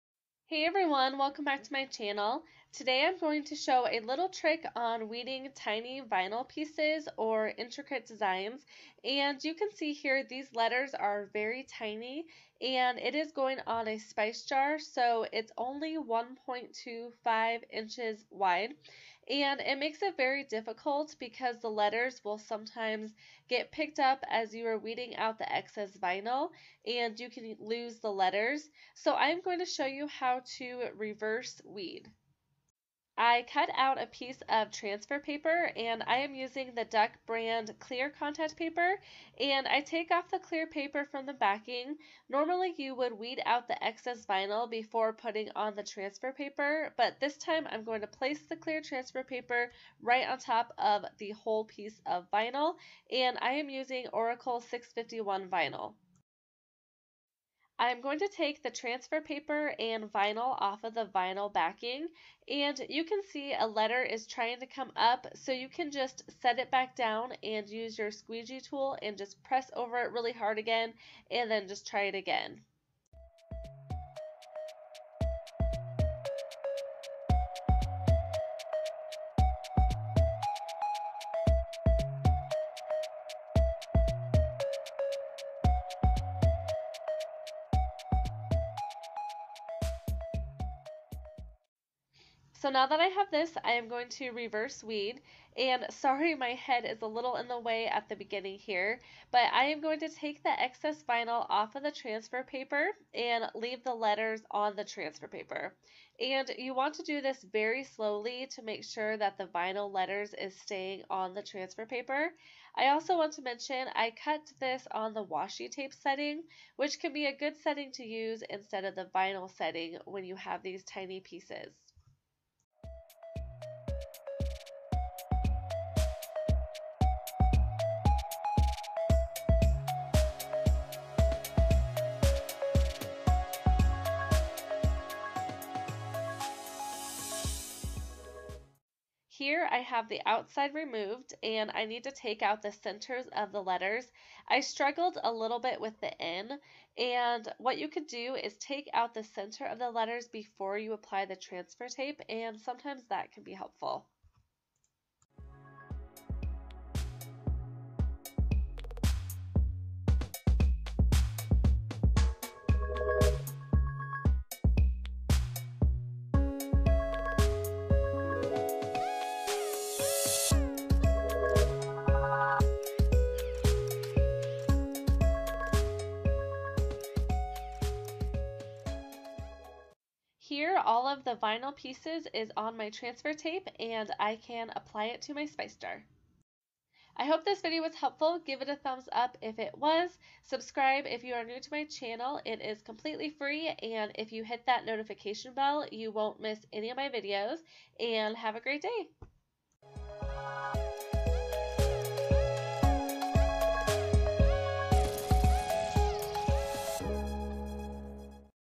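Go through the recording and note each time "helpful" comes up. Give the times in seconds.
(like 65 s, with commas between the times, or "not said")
153 s, 187 s.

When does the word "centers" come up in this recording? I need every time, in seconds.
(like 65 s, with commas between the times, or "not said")
142 s, 149 s.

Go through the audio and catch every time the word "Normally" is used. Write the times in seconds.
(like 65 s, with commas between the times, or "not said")
42 s.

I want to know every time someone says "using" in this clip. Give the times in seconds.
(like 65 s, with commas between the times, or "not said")
36 s, 53 s.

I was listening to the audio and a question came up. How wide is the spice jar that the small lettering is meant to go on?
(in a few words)
1.25 inches.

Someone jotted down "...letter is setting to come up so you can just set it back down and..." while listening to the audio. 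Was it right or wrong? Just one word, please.
wrong.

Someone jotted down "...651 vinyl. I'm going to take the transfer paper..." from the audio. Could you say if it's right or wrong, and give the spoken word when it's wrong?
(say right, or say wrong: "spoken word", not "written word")
right.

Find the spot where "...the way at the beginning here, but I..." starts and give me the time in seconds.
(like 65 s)
97 s.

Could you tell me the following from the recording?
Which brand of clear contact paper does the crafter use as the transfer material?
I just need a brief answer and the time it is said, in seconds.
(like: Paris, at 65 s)
Duck brand, at 36 s.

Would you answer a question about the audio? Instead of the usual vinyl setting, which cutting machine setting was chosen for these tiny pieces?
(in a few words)
washi tape setting.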